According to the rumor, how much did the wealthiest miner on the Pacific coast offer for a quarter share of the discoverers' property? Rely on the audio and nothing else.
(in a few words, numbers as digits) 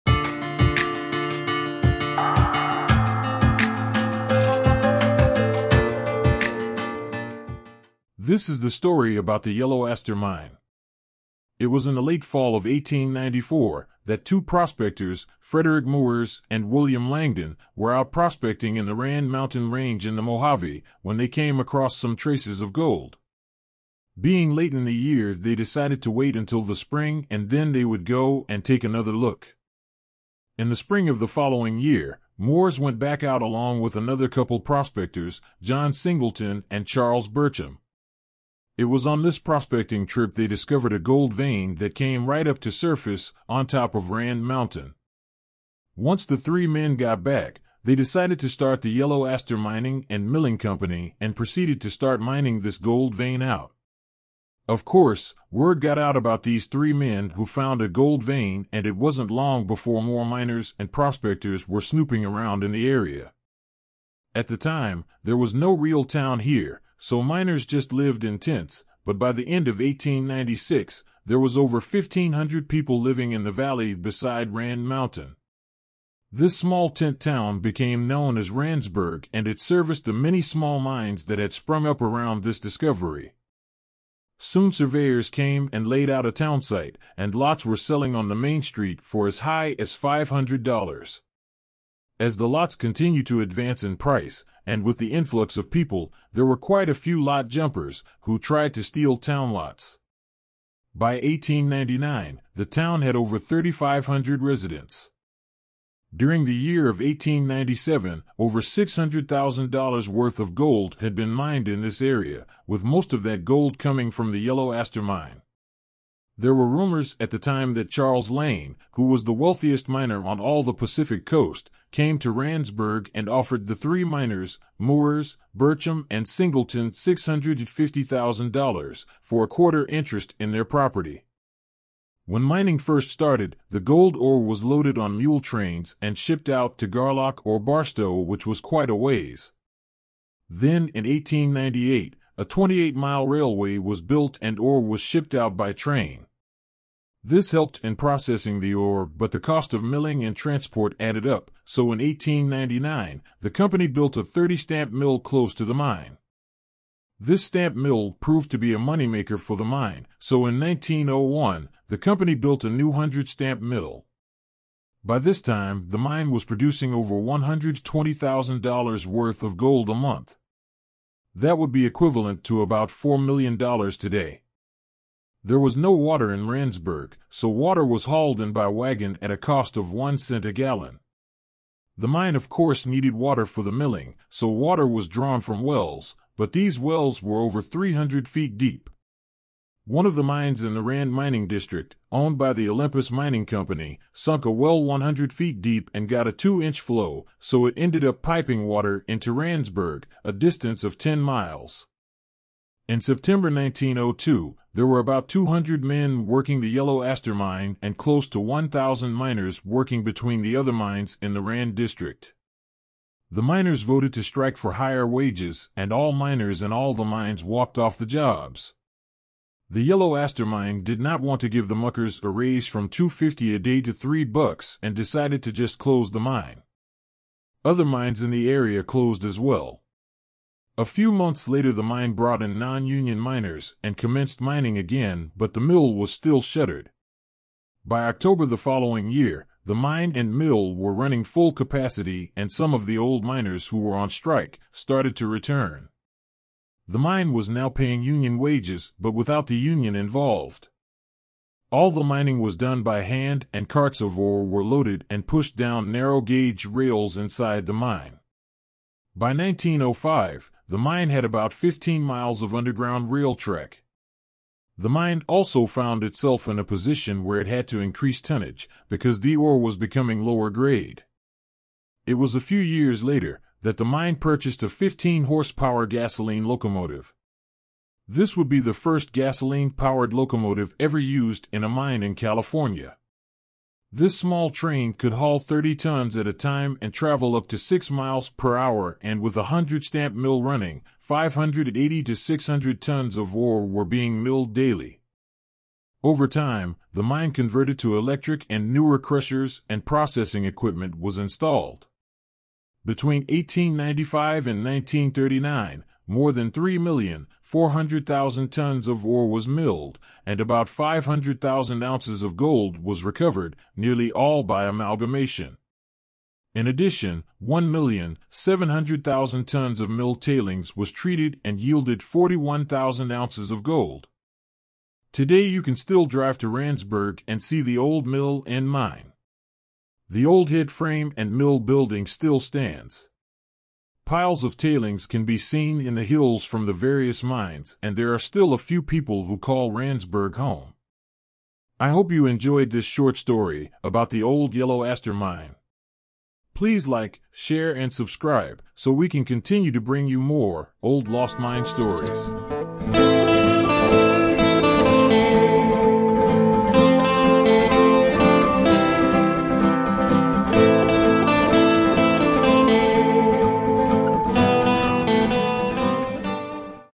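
$650,000.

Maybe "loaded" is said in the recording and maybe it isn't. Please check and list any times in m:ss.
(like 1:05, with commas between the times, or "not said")
2:14, 4:14.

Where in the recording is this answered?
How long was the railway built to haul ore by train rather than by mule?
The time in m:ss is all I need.
2:22.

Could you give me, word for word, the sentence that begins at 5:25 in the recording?
Today you can still drive to Randsburg and see the old mill and mine.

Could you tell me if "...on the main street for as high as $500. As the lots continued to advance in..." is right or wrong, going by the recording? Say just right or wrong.
right.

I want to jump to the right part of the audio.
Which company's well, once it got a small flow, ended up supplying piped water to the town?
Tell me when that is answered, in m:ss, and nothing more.
3:12.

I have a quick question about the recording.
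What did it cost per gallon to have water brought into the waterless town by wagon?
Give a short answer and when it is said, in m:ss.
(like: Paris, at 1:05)
one cent, at 2:59.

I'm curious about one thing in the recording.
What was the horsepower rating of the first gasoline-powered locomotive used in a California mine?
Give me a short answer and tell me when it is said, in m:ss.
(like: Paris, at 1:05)
15 horsepower, at 4:34.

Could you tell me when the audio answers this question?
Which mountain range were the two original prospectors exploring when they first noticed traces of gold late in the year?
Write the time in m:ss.
0:18.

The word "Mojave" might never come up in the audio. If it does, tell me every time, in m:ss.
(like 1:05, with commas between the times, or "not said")
0:20.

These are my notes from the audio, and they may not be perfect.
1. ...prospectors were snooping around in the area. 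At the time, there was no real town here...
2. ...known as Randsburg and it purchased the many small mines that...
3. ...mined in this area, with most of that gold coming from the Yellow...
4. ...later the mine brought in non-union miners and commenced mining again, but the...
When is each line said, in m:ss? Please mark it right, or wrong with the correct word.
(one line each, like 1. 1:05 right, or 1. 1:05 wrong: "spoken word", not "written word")
1. 1:00 right
2. 1:18 wrong: "serviced", not "purchased"
3. 1:51 right
4. 3:51 right.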